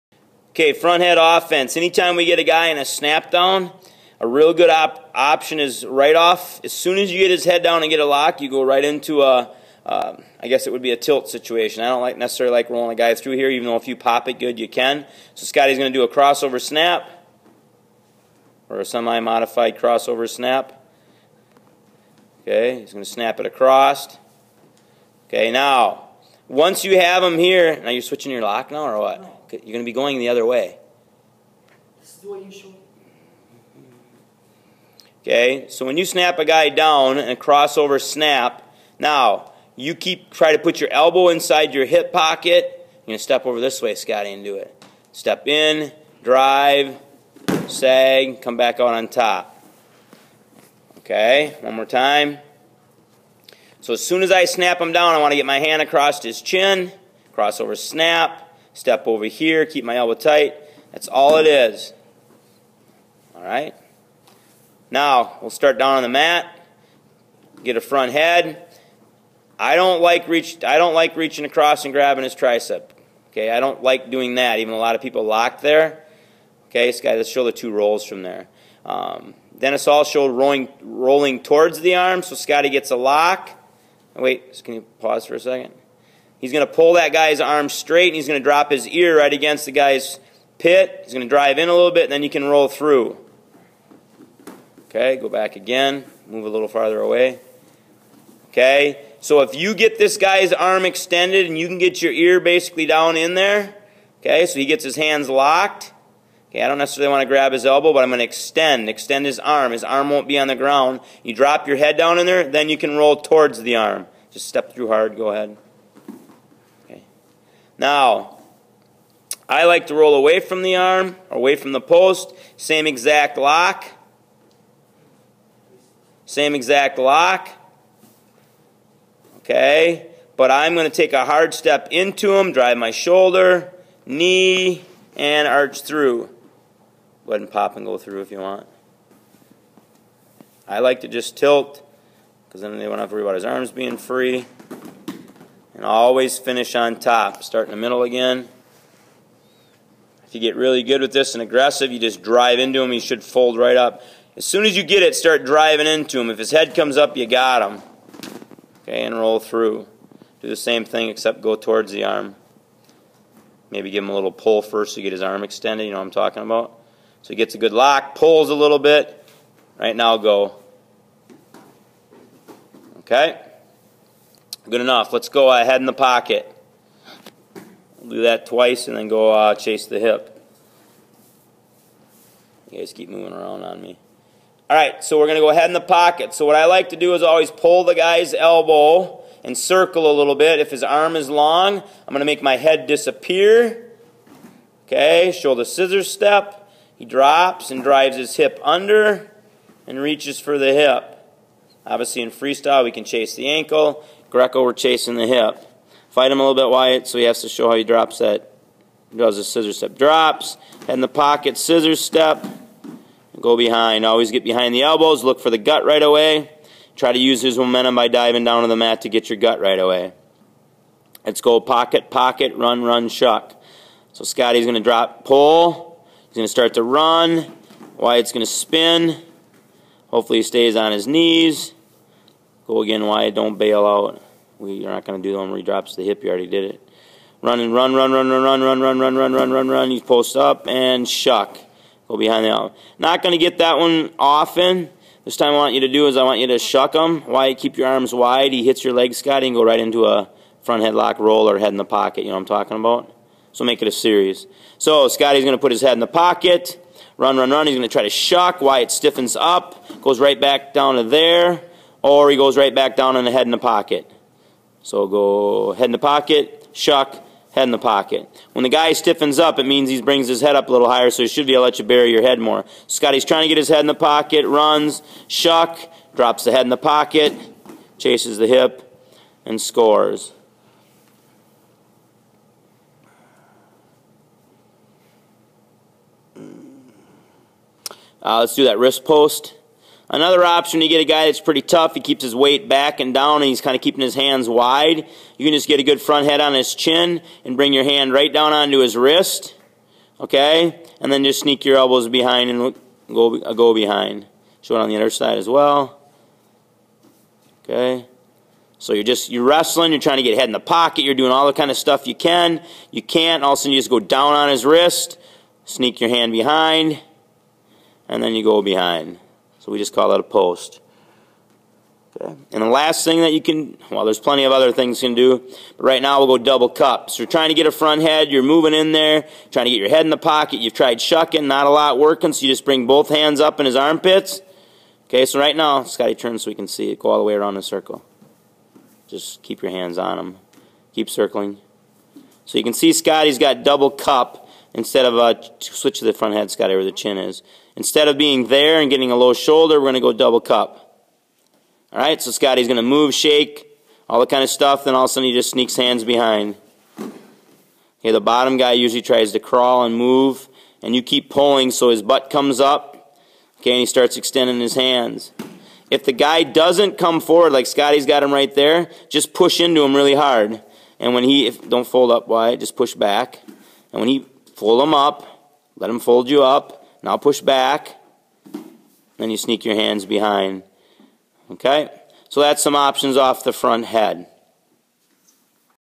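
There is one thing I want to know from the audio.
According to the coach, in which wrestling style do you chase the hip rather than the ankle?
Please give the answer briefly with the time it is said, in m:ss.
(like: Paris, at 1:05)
Greco, at 3:24.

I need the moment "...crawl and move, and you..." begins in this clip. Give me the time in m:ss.
5:59.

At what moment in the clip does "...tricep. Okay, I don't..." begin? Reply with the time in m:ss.
1:12.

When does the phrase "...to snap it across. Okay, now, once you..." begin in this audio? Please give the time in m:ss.
0:23.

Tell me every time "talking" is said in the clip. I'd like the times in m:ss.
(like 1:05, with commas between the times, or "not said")
2:46, 4:12.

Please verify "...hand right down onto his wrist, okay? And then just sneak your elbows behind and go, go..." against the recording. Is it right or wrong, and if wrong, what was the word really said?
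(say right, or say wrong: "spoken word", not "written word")
right.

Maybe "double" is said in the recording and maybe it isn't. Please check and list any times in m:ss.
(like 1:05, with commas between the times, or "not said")
5:26, 5:43, 5:50.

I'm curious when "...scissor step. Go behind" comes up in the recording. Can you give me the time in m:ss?
3:31.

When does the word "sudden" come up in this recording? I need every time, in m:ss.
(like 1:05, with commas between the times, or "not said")
5:13, 5:55.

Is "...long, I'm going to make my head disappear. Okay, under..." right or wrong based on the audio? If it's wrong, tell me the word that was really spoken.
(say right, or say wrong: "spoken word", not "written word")
wrong: "shoulder", not "under".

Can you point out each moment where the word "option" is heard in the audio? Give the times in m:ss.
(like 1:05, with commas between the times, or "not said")
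0:05, 4:50, 6:22.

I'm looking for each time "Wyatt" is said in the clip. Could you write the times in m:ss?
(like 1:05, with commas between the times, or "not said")
3:47, 4:18.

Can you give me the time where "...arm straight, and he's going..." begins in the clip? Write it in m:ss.
1:27.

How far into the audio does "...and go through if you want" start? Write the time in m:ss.
2:17.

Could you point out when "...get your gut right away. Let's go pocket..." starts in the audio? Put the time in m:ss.
3:39.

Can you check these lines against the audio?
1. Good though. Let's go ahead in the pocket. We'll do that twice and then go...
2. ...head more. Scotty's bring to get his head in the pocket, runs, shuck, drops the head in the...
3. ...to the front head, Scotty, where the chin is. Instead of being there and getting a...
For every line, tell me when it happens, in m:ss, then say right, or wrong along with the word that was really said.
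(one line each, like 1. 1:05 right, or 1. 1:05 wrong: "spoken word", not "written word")
1. 2:54 wrong: "enough", not "though"
2. 4:32 wrong: "trying", not "bring"
3. 5:45 right.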